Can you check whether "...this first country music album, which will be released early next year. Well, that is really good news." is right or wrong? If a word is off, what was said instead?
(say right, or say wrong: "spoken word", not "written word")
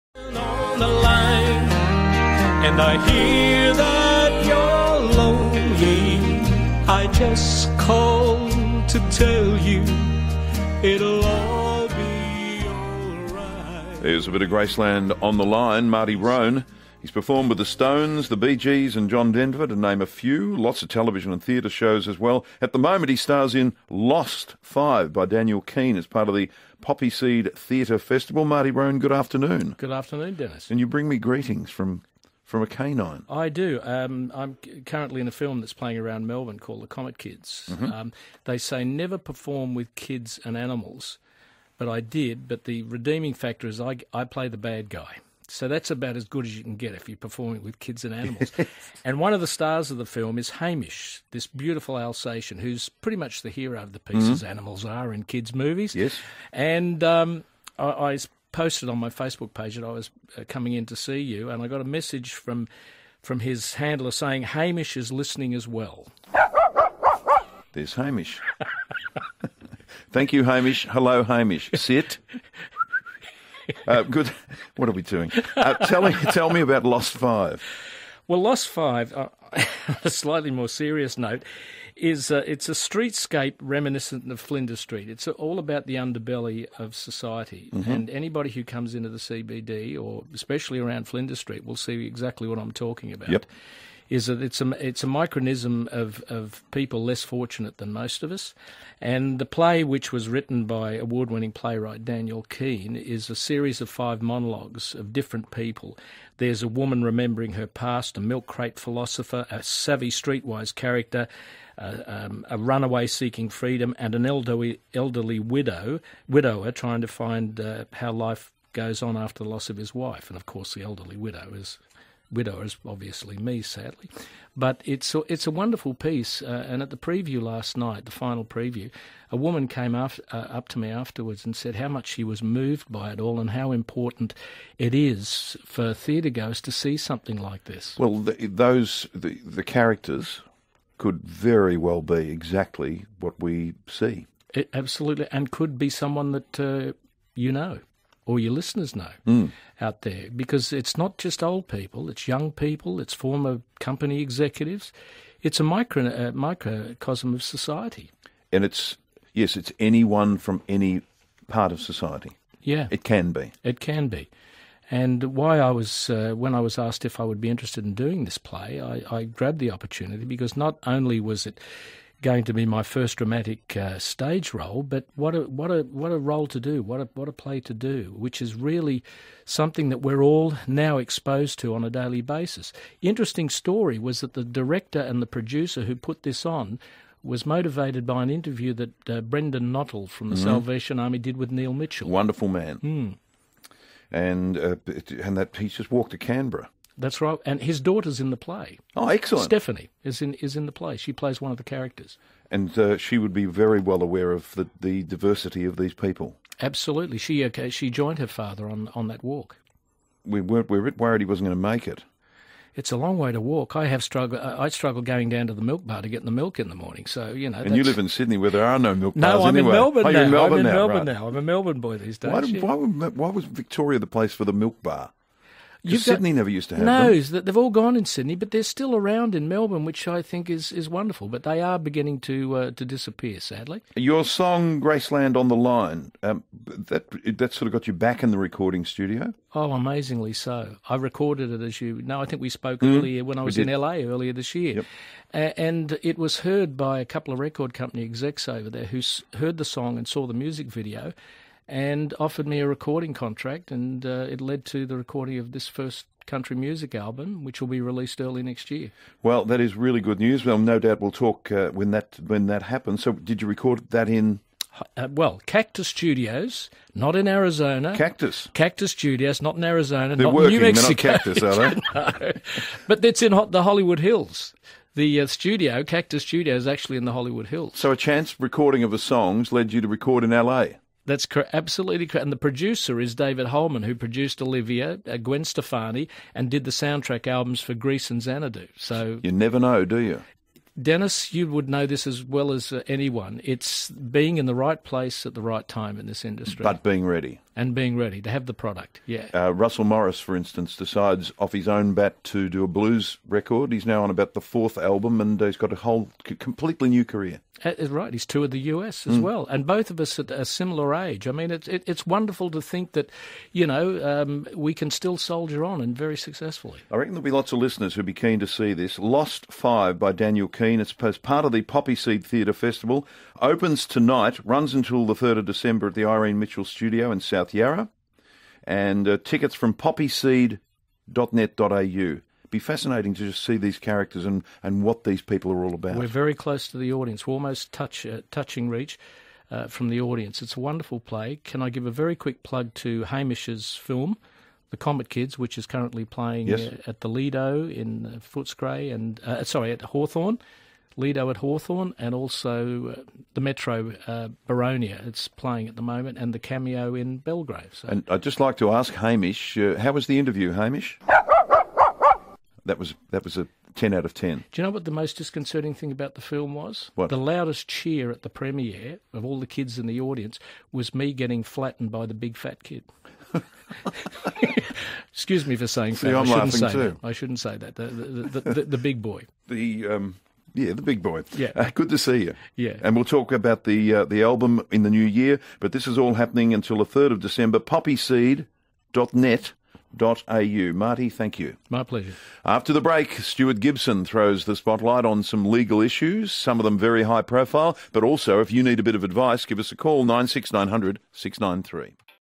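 right.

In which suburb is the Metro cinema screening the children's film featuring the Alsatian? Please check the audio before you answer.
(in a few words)
Boronia.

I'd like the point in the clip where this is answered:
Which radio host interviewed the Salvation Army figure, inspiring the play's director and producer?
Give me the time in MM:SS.
03:11.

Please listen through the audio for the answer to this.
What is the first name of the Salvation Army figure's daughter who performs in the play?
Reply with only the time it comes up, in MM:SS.
03:19.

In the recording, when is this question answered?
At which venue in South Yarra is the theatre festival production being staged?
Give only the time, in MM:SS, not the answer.
05:26.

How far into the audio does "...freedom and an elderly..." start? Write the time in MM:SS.
01:53.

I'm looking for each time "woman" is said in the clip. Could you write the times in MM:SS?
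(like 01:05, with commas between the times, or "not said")
01:46, 02:09.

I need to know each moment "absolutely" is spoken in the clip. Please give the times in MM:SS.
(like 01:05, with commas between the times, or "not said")
02:24, 03:26, 04:41.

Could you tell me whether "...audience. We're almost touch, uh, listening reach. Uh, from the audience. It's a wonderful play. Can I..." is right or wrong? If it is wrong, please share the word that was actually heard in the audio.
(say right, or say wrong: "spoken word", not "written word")
wrong: "touching", not "listening".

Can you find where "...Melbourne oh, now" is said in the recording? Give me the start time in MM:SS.
03:39.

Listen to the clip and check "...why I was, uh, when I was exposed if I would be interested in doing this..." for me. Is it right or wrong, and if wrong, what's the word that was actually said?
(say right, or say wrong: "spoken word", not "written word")
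wrong: "asked", not "exposed".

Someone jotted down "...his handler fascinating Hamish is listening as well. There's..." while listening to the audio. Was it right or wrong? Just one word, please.
wrong.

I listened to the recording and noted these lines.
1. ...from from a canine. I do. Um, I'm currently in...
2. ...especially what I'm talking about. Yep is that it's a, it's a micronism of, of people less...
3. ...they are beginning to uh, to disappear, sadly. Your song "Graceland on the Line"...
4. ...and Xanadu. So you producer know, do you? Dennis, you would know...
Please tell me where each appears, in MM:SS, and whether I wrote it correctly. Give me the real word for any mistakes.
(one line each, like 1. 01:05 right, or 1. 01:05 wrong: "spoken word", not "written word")
1. 00:31 right
2. 01:32 wrong: "exactly", not "especially"
3. 03:51 right
4. 04:48 wrong: "never", not "producer".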